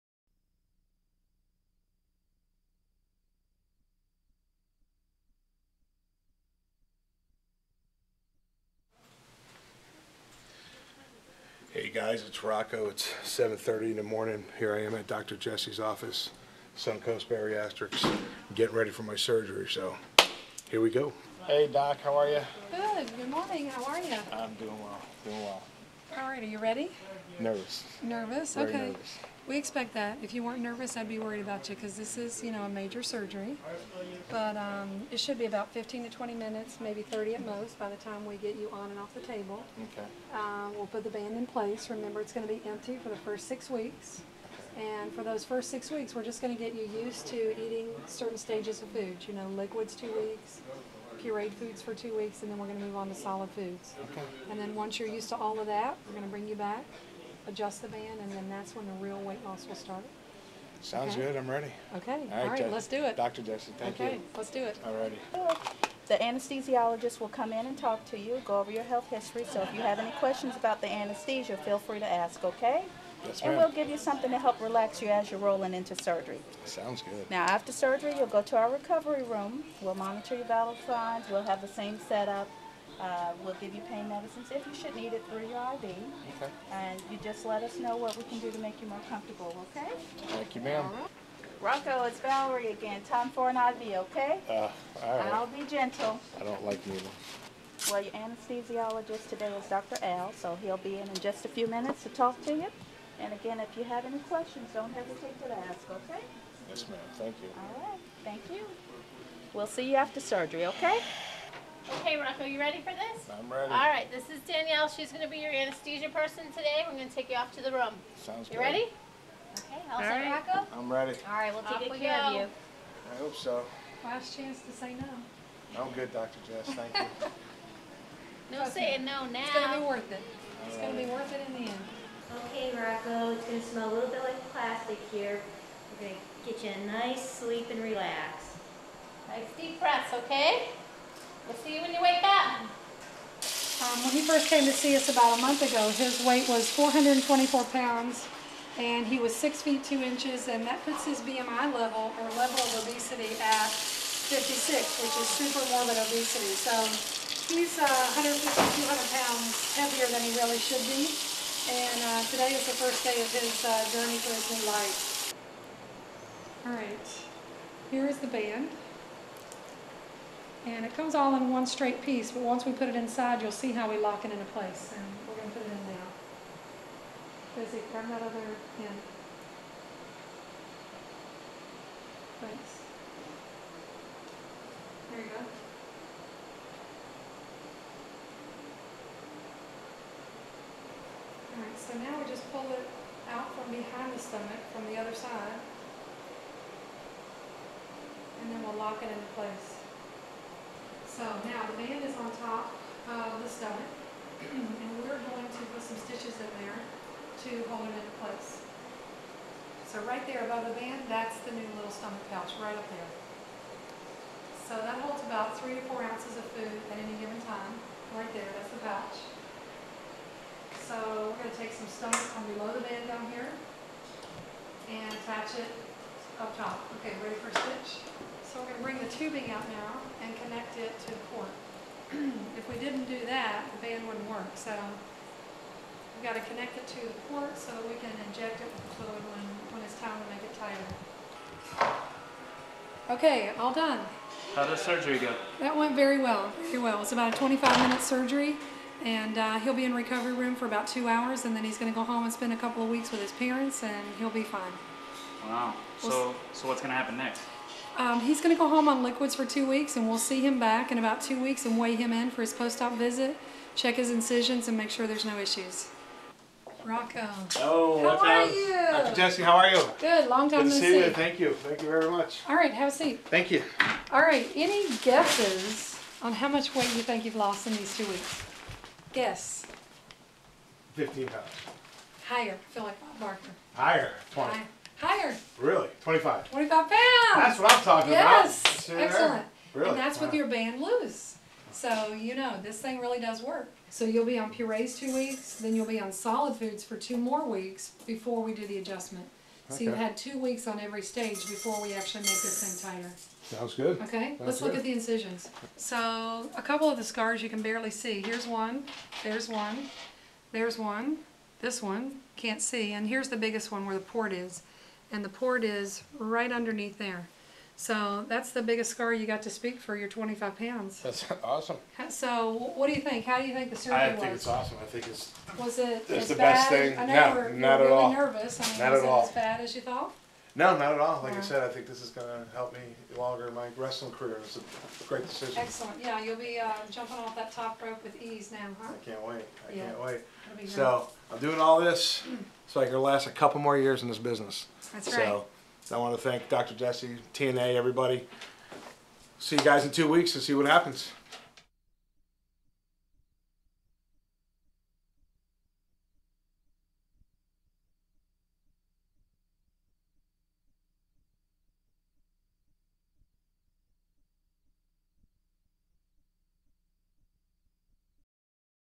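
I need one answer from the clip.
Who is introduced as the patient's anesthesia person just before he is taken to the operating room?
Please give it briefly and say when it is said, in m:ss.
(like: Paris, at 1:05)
Danielle, at 1:54.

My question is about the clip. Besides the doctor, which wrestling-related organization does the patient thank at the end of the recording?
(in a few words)
TNA.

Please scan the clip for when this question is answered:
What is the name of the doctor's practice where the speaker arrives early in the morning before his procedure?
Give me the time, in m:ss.
0:16.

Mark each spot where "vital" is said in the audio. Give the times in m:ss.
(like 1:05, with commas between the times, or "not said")
1:20.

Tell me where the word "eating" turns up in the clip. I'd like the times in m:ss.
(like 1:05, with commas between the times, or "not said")
0:47.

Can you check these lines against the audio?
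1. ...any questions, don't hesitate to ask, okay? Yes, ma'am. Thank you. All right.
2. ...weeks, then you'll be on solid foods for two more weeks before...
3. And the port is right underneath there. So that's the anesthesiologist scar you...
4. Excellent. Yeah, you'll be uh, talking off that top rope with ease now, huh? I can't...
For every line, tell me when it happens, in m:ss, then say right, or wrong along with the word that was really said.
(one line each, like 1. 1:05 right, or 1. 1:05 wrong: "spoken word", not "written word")
1. 1:44 right
2. 4:55 right
3. 5:15 wrong: "biggest", not "anesthesiologist"
4. 5:35 wrong: "jumping", not "talking".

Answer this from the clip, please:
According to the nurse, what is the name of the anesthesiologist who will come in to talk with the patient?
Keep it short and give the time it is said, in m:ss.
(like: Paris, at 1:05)
Dr. Al, at 1:39.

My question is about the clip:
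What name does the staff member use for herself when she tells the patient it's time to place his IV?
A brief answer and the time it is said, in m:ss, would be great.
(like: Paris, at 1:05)
Valerie, at 1:32.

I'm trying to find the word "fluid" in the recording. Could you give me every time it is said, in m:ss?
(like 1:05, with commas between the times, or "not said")
3:59.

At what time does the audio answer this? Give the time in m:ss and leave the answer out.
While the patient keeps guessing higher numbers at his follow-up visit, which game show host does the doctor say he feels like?
4:43.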